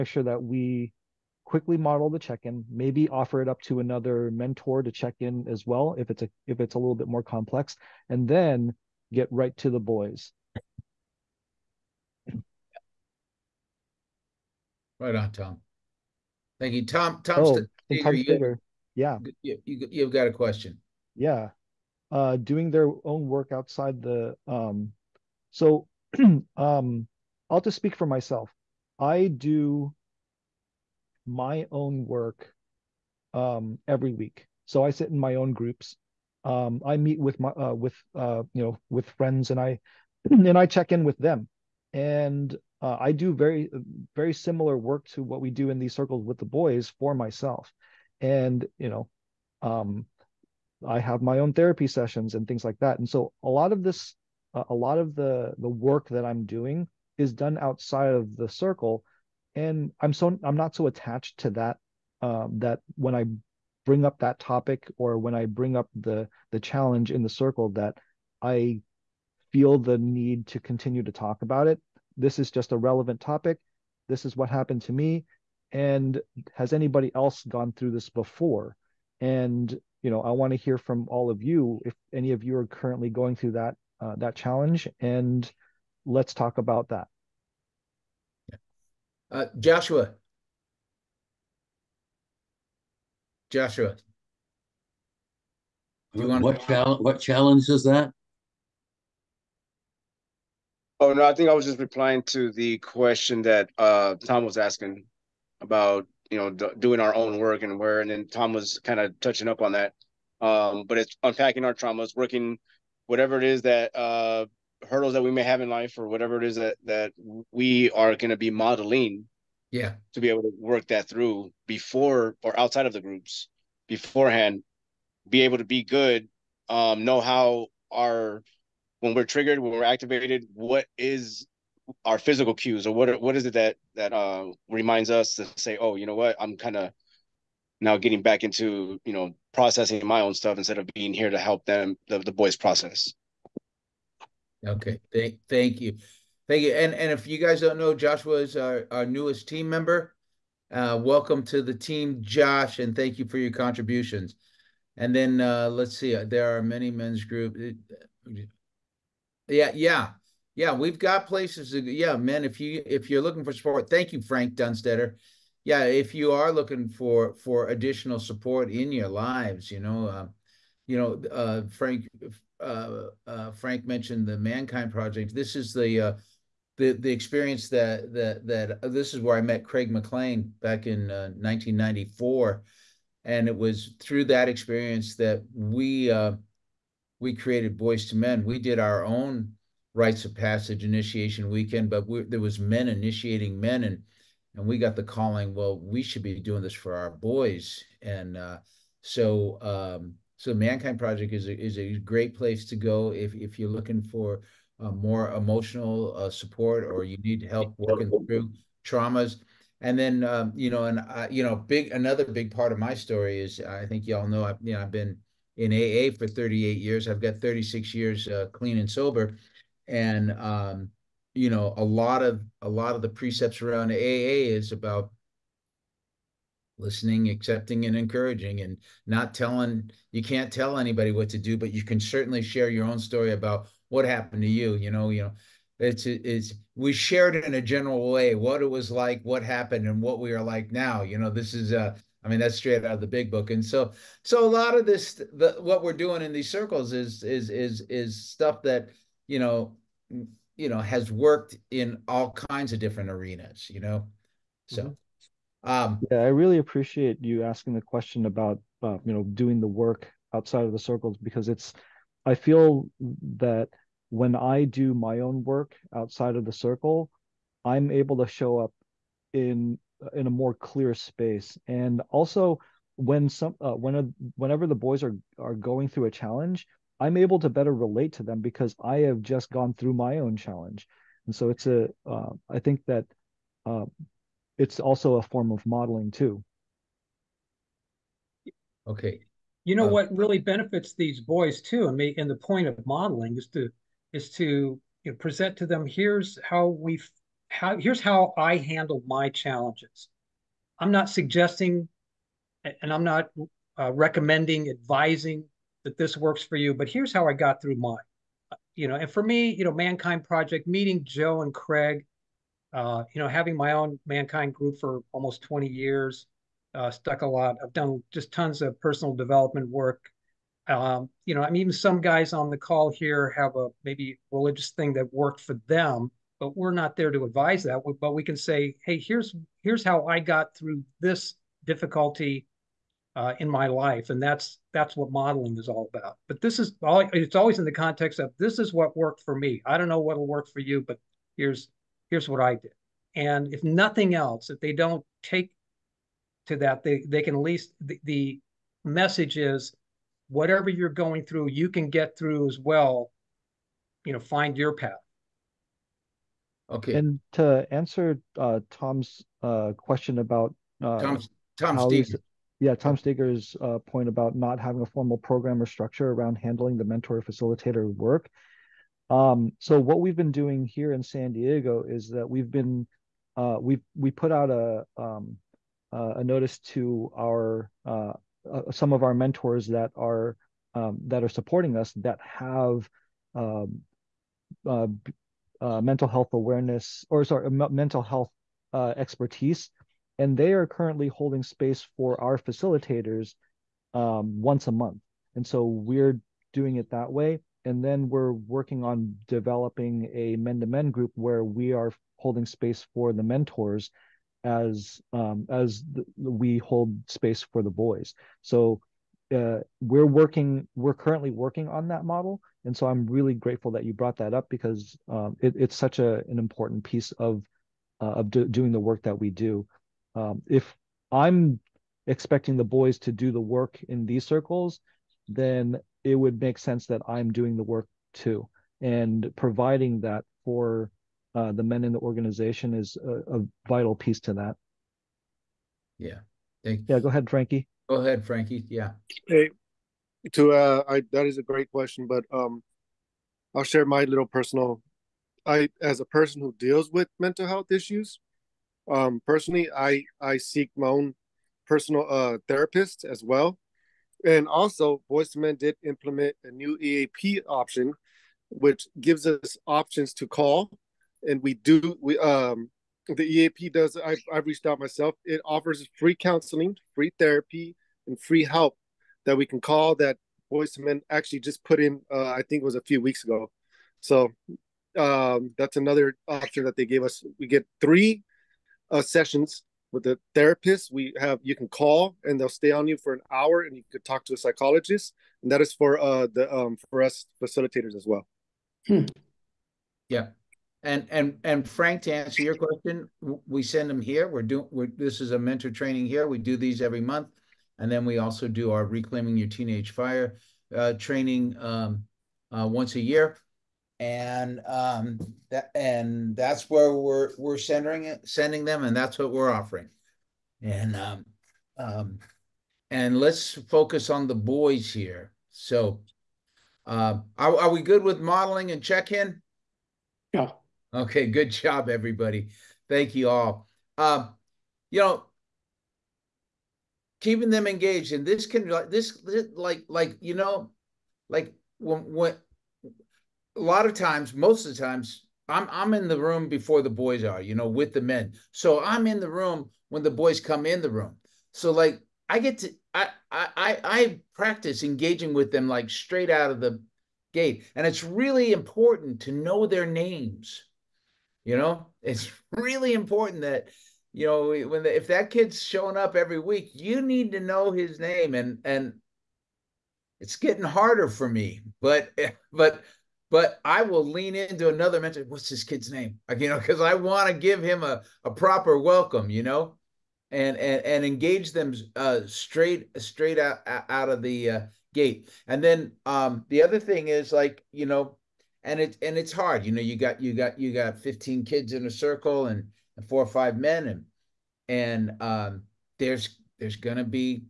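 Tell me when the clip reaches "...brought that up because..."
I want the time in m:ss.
6:53.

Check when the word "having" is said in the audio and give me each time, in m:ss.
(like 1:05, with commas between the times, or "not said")
5:13, 6:04.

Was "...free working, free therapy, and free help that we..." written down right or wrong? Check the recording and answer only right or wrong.
wrong.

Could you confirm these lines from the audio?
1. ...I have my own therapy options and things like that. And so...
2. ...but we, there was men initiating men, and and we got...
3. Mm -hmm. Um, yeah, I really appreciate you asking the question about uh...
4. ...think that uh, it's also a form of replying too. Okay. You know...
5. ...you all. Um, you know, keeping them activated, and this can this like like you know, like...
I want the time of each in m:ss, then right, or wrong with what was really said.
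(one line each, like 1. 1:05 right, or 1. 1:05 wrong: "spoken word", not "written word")
1. 0:50 wrong: "sessions", not "options"
2. 3:11 right
3. 4:14 right
4. 4:42 wrong: "modeling", not "replying"
5. 8:43 wrong: "engaged", not "activated".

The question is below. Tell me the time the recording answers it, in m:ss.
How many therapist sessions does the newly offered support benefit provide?
7:57.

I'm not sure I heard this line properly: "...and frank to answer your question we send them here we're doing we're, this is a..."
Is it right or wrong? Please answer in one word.
right.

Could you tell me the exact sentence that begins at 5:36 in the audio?
But this is all, it's always in the context of this is what worked for me.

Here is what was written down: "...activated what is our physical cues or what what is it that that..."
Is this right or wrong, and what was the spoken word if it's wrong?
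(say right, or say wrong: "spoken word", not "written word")
right.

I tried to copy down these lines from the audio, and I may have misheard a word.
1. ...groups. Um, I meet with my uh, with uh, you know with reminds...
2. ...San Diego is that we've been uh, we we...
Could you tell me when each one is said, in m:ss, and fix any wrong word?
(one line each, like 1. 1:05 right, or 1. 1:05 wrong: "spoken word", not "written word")
1. 0:35 wrong: "friends", not "reminds"
2. 6:11 right.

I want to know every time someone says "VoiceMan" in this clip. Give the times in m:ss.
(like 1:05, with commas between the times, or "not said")
7:35, 7:50.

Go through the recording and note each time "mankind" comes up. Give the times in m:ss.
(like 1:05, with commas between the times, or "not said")
2:54, 3:20, 5:09, 5:14.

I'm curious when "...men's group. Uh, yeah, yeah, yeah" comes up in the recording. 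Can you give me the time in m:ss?
2:36.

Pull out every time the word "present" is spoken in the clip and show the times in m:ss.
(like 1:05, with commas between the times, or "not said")
4:55.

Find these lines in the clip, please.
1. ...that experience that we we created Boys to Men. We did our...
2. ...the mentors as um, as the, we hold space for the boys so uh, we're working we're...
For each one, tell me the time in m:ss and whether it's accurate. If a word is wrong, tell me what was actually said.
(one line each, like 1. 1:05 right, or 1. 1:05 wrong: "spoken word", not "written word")
1. 3:04 right
2. 6:43 right.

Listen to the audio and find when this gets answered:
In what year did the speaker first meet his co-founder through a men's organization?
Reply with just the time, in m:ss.
3:01.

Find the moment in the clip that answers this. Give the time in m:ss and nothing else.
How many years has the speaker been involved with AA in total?
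3:36.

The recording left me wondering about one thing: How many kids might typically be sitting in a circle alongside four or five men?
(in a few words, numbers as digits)
15.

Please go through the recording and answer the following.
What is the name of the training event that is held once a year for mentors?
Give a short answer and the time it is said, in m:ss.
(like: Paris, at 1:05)
Reclaiming Your Teenage Fire, at 8:18.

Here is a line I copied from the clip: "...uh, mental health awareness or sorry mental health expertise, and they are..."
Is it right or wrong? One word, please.
right.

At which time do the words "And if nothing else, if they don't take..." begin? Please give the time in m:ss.
5:43.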